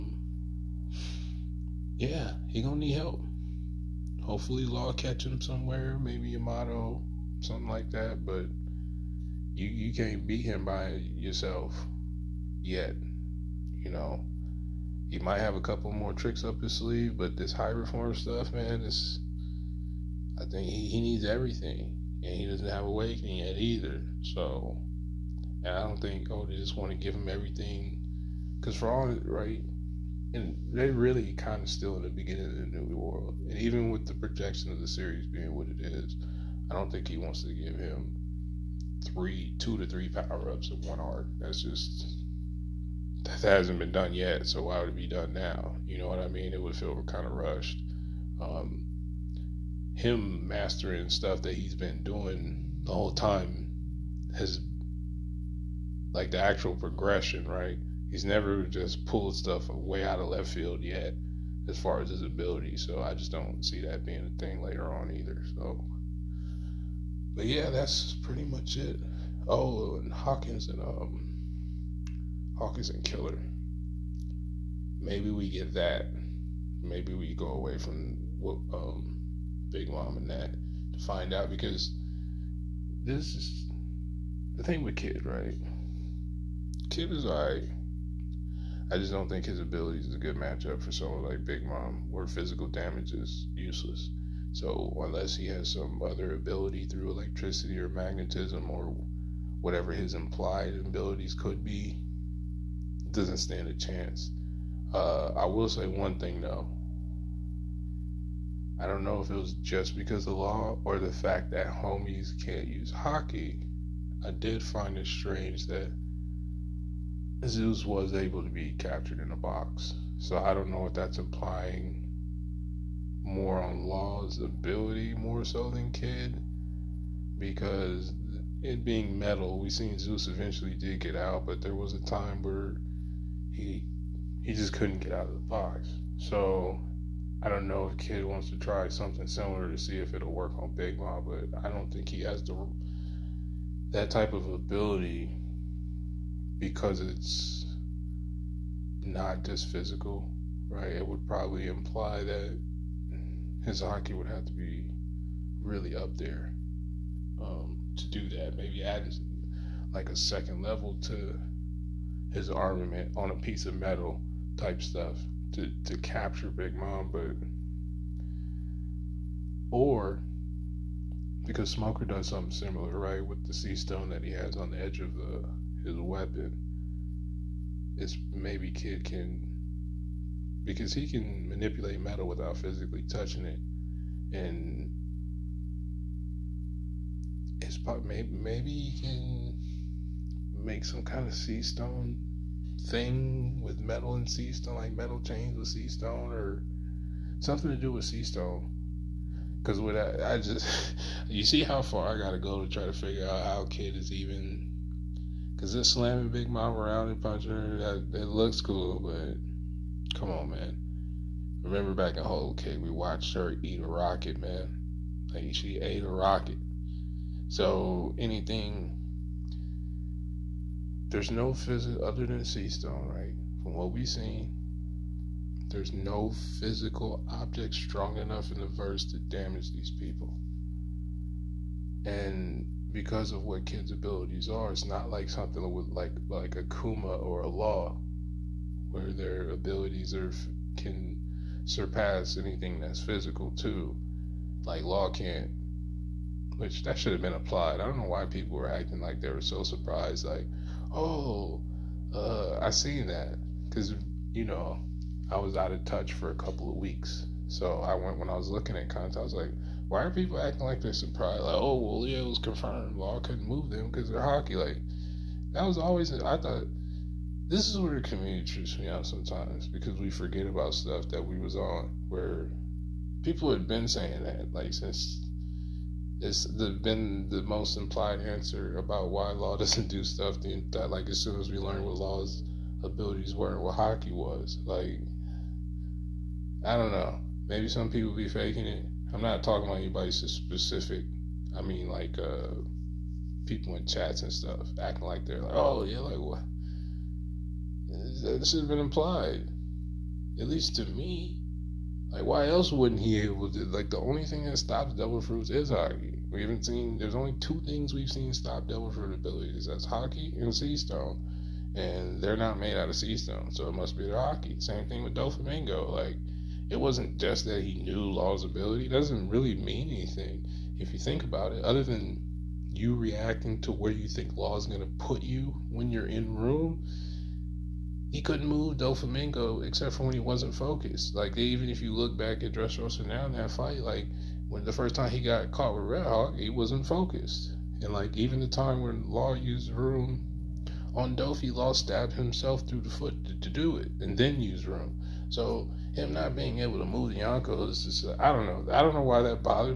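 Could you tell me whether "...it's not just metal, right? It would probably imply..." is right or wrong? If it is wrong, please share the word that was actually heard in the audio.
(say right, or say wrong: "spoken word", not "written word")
wrong: "physical", not "metal".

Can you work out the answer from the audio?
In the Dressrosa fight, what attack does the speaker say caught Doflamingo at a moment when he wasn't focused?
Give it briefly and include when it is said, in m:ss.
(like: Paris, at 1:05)
Red Hawk, at 5:35.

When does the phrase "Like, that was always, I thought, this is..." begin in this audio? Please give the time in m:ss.
4:24.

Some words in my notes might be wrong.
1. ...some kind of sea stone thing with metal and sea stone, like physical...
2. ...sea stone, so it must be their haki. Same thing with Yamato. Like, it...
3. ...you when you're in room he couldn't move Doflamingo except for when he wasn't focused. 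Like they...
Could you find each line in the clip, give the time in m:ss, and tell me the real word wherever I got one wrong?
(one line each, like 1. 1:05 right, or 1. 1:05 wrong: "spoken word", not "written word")
1. 3:10 wrong: "metal", not "physical"
2. 5:12 wrong: "Doflamingo", not "Yamato"
3. 5:25 right.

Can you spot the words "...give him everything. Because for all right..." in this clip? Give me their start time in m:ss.
0:26.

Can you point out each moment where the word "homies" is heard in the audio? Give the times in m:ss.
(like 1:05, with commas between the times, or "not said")
1:51.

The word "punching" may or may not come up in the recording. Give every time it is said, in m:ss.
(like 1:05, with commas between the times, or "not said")
3:27.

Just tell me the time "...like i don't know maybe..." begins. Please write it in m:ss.
4:44.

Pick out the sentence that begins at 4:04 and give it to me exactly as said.
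Like law can't, which that should have been applied.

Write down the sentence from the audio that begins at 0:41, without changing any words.
That's just that hasn't been done yet.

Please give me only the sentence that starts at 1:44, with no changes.
Uh, I will say one thing though.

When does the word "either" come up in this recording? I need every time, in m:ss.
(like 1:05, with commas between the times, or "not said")
0:23, 1:05.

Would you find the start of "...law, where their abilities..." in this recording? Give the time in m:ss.
3:57.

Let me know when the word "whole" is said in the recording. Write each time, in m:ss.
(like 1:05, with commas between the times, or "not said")
0:52, 3:32.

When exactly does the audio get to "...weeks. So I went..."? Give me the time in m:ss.
4:16.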